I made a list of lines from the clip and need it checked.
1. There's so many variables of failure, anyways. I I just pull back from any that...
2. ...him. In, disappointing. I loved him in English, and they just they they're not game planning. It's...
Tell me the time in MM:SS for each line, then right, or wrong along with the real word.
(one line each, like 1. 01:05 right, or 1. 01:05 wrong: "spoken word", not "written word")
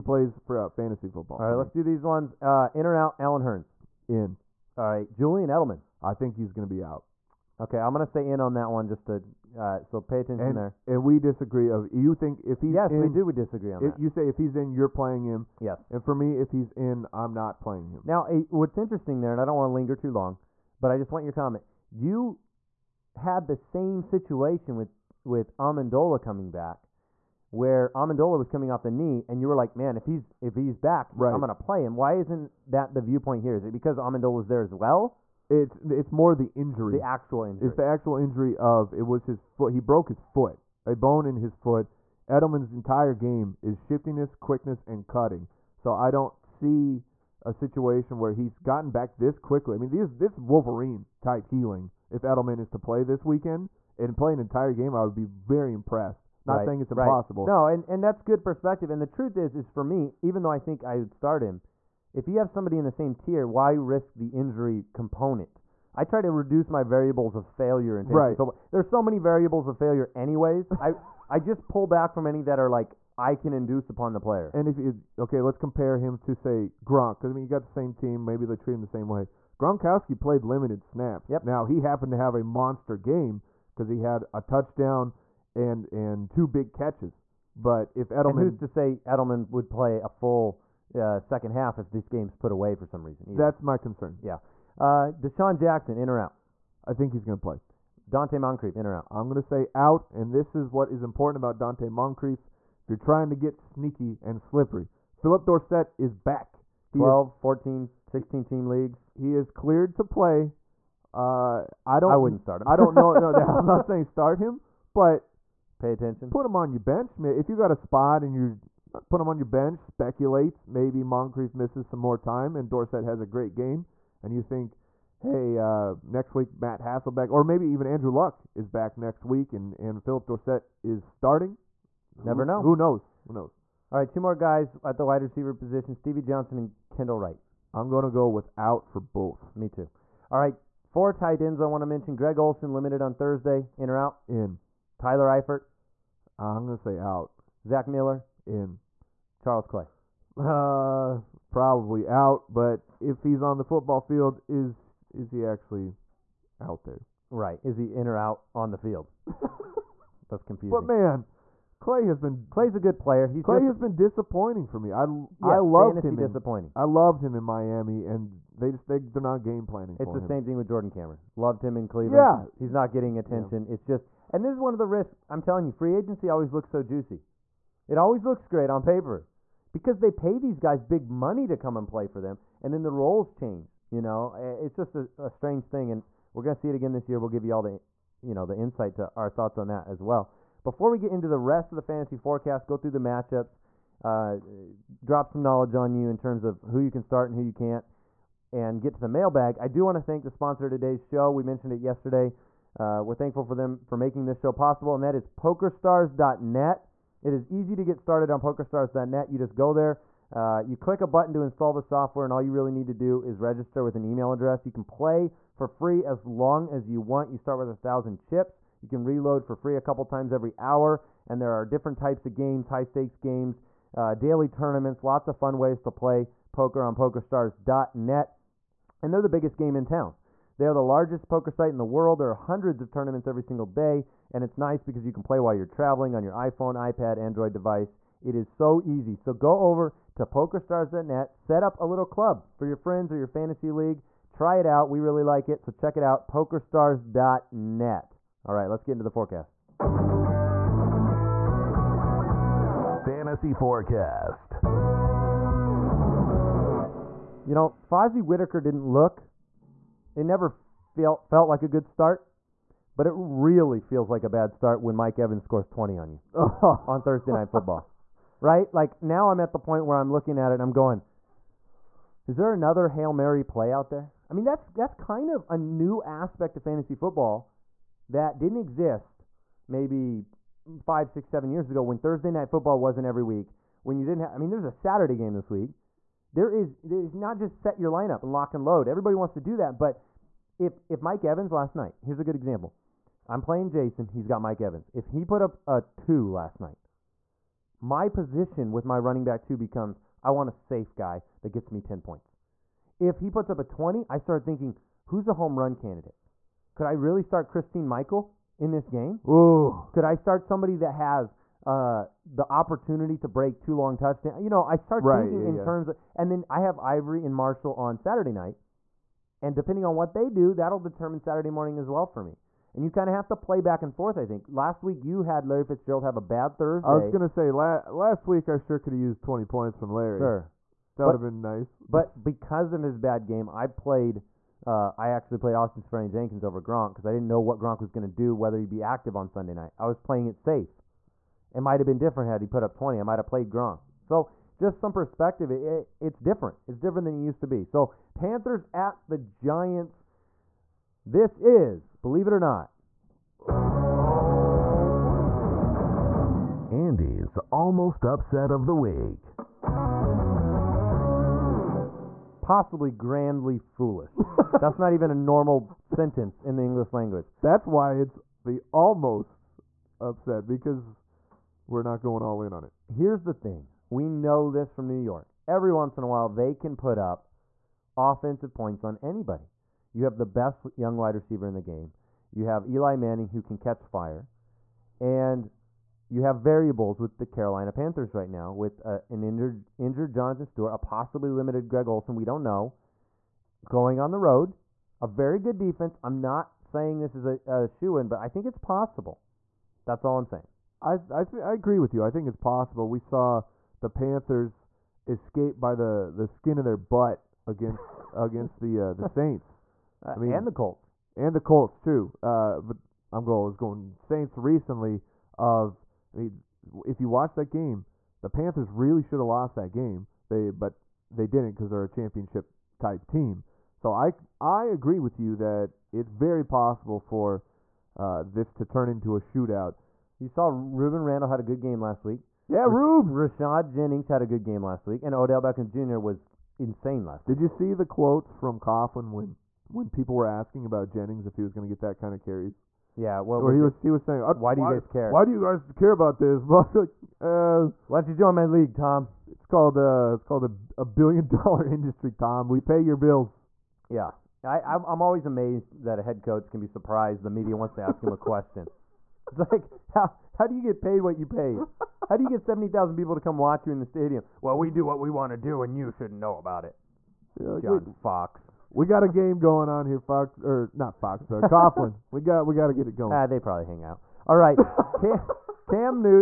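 1. 01:08 right
2. 02:46 wrong: "Miami", not "English".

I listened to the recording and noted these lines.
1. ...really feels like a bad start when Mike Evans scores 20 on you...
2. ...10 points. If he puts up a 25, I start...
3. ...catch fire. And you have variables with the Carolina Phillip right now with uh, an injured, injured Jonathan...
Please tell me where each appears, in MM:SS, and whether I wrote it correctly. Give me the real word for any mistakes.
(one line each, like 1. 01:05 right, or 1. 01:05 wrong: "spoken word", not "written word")
1. 04:23 right
2. 05:01 wrong: "20", not "25"
3. 06:23 wrong: "Panthers", not "Phillip".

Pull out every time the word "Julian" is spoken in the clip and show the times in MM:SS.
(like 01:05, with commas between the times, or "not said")
00:05.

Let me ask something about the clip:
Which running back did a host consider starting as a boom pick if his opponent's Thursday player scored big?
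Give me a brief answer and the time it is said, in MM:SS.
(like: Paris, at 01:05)
Christine Michael, at 05:07.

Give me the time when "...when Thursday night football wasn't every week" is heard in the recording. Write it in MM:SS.
04:41.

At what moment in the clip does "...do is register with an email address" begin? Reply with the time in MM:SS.
03:32.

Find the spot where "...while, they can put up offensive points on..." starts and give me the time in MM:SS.
06:16.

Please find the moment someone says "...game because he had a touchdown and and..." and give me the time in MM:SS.
01:22.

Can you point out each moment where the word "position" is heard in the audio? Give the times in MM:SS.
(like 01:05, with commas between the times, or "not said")
02:15, 04:58.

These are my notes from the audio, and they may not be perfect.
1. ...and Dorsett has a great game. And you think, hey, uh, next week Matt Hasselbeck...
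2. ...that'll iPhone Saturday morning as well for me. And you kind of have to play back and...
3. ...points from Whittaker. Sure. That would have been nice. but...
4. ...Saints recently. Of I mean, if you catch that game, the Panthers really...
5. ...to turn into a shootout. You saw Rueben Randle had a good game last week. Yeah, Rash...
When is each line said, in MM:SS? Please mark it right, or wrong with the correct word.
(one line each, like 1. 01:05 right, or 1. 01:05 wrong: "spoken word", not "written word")
1. 02:02 right
2. 05:20 wrong: "determine", not "iPhone"
3. 05:29 wrong: "Larry", not "Whittaker"
4. 06:53 wrong: "watch", not "catch"
5. 07:08 right.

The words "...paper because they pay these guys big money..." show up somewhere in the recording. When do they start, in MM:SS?
02:58.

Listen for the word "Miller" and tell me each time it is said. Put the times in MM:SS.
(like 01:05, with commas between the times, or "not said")
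02:27.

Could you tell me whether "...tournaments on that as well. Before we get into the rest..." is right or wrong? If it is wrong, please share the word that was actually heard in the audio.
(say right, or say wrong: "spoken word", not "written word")
wrong: "thoughts", not "tournaments".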